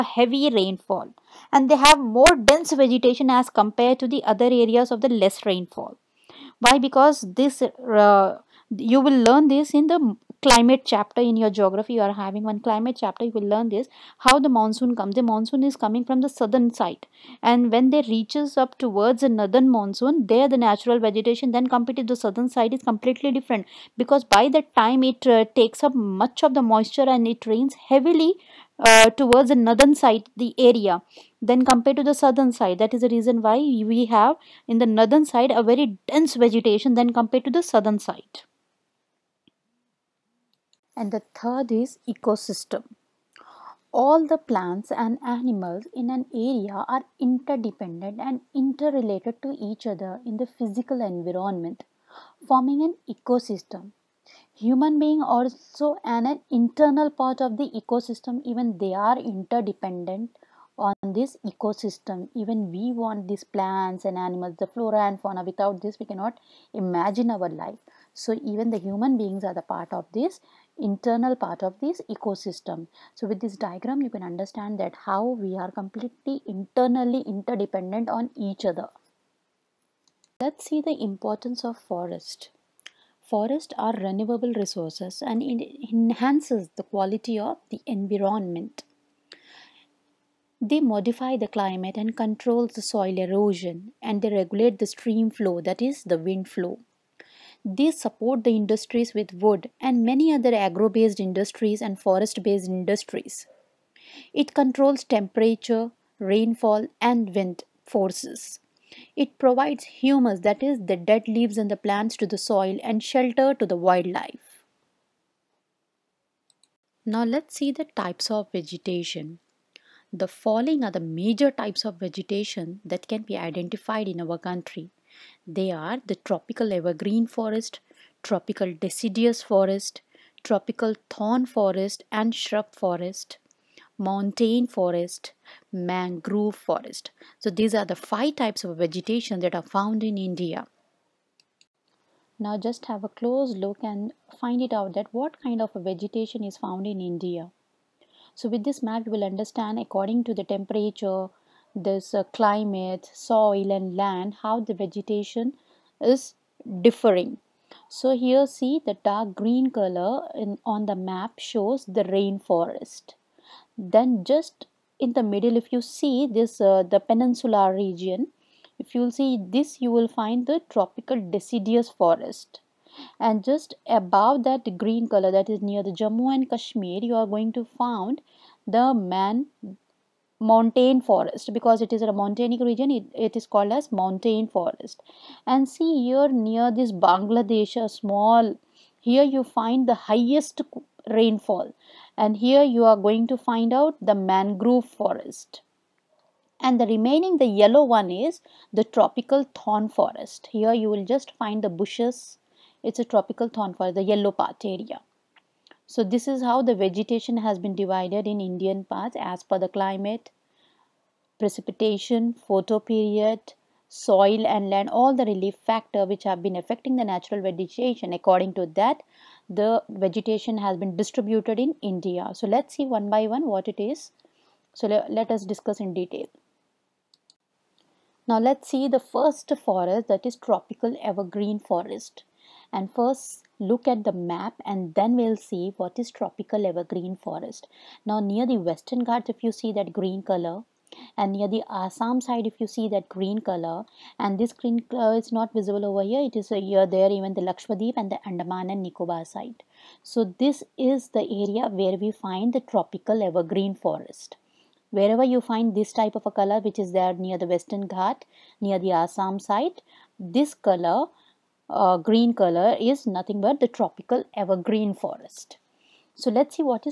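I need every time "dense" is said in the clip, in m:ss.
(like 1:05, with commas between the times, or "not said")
0:02, 0:36.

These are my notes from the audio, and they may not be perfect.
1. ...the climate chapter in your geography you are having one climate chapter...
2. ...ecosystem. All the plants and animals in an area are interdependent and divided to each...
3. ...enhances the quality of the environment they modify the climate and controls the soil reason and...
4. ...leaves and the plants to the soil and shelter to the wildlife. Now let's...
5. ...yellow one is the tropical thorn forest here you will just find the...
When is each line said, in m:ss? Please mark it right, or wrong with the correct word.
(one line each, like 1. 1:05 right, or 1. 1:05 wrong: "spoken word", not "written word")
1. 0:09 right
2. 0:42 wrong: "interrelated", not "divided"
3. 1:25 wrong: "erosion", not "reason"
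4. 1:51 right
5. 3:17 right.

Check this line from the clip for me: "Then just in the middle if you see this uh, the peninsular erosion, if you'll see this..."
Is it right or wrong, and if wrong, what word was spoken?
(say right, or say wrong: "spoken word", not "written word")
wrong: "region", not "erosion".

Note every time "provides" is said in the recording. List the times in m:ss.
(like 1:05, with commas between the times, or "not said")
1:49.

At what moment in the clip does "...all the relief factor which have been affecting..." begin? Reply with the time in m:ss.
3:34.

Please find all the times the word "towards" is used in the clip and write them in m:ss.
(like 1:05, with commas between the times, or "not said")
0:18, 0:29.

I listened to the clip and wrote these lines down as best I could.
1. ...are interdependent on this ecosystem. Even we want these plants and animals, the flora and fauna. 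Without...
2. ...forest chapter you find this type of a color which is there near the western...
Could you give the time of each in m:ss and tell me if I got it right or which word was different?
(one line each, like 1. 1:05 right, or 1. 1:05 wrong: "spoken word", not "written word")
1. 0:58 right
2. 4:13 wrong: "wherever", not "chapter".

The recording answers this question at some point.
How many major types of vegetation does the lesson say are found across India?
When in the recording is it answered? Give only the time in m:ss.
2:17.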